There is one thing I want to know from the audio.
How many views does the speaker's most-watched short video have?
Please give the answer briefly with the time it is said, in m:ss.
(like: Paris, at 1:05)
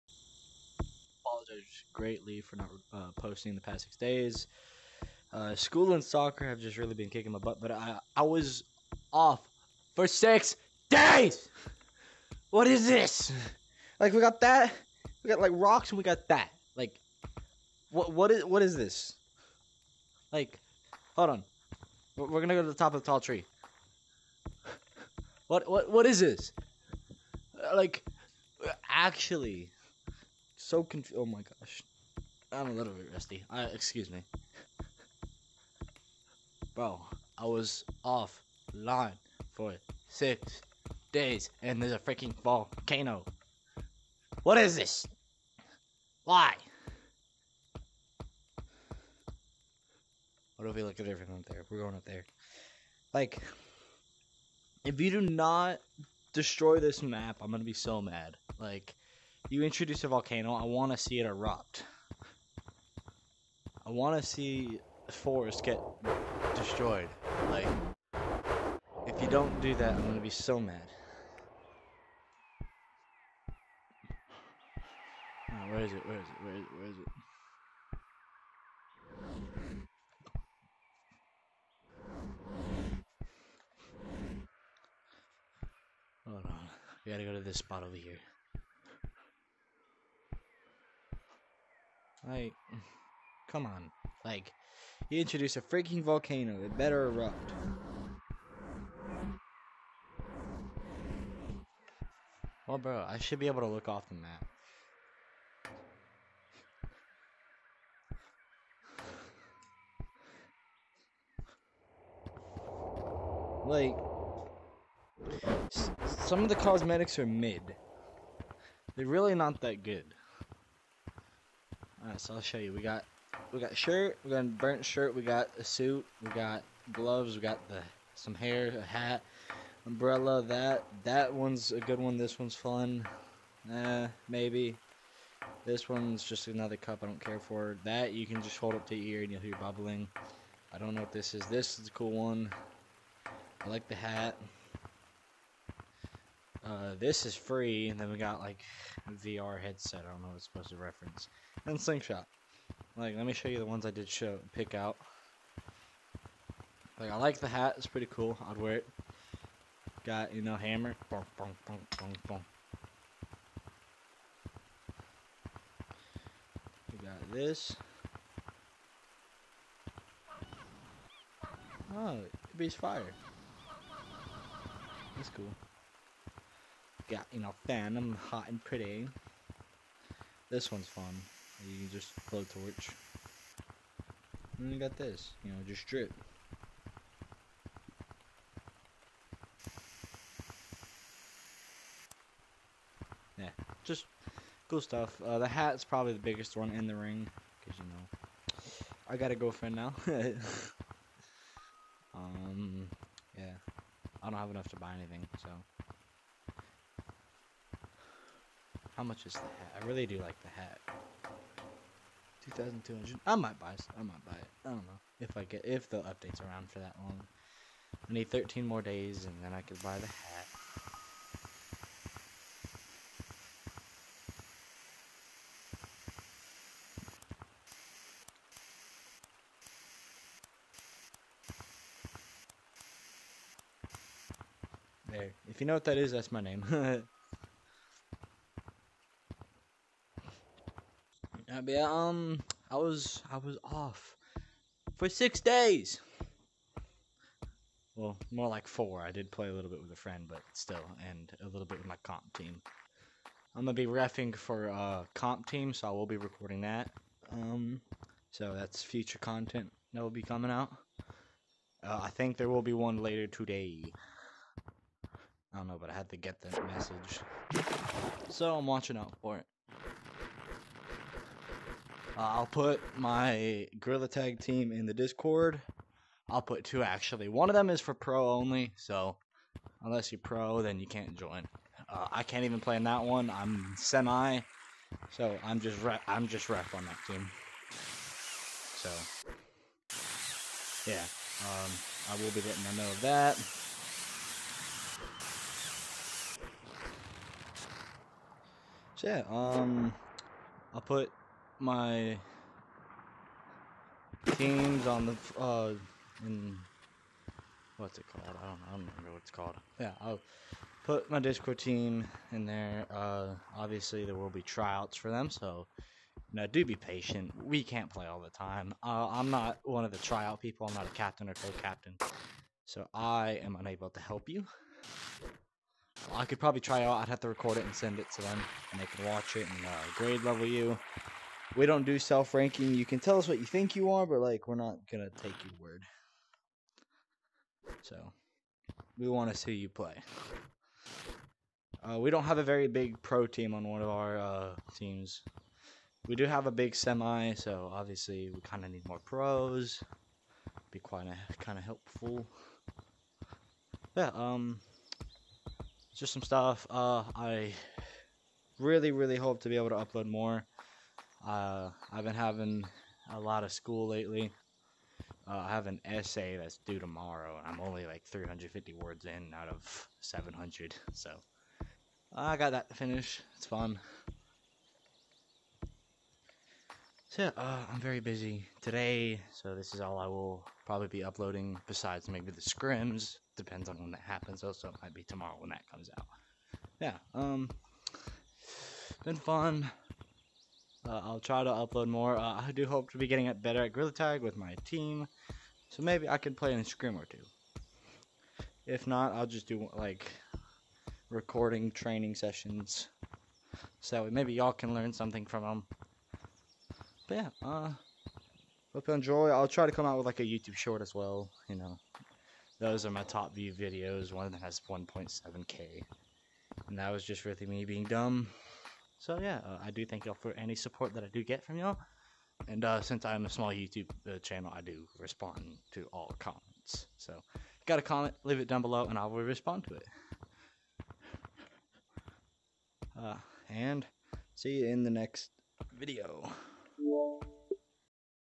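1.7k, at 6:54.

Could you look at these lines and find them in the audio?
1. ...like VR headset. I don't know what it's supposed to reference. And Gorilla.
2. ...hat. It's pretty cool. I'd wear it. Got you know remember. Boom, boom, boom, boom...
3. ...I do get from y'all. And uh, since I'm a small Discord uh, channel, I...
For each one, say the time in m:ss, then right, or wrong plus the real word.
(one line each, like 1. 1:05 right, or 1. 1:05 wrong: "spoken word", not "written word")
1. 2:28 wrong: "Slingshot", not "Gorilla"
2. 2:37 wrong: "hammer", not "remember"
3. 7:01 wrong: "YouTube", not "Discord".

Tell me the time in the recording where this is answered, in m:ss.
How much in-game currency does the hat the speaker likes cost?
3:32.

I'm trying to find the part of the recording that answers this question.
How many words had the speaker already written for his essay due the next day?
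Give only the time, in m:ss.
6:08.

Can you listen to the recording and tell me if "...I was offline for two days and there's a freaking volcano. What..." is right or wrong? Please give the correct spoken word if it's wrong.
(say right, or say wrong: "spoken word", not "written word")
wrong: "six", not "two".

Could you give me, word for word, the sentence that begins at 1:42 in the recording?
Well, bro, I should be able to look off the map.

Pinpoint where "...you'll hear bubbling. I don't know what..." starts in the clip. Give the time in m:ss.
2:19.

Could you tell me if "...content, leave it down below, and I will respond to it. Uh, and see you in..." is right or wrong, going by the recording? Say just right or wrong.
wrong.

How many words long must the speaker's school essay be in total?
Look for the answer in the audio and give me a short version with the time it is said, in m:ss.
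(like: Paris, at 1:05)
700, at 6:10.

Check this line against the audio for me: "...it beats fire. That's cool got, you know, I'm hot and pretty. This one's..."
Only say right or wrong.
right.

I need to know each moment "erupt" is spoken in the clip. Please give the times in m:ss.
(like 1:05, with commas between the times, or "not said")
1:01, 1:37.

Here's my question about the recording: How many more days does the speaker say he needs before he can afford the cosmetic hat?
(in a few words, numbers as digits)
13.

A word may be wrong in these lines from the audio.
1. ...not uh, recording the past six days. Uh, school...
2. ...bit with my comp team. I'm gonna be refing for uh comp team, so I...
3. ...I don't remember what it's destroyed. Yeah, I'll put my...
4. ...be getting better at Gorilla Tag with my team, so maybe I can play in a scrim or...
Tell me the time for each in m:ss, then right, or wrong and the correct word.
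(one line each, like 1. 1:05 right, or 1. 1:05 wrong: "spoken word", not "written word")
1. 0:02 wrong: "posting", not "recording"
2. 4:11 right
3. 5:08 wrong: "called", not "destroyed"
4. 6:32 right.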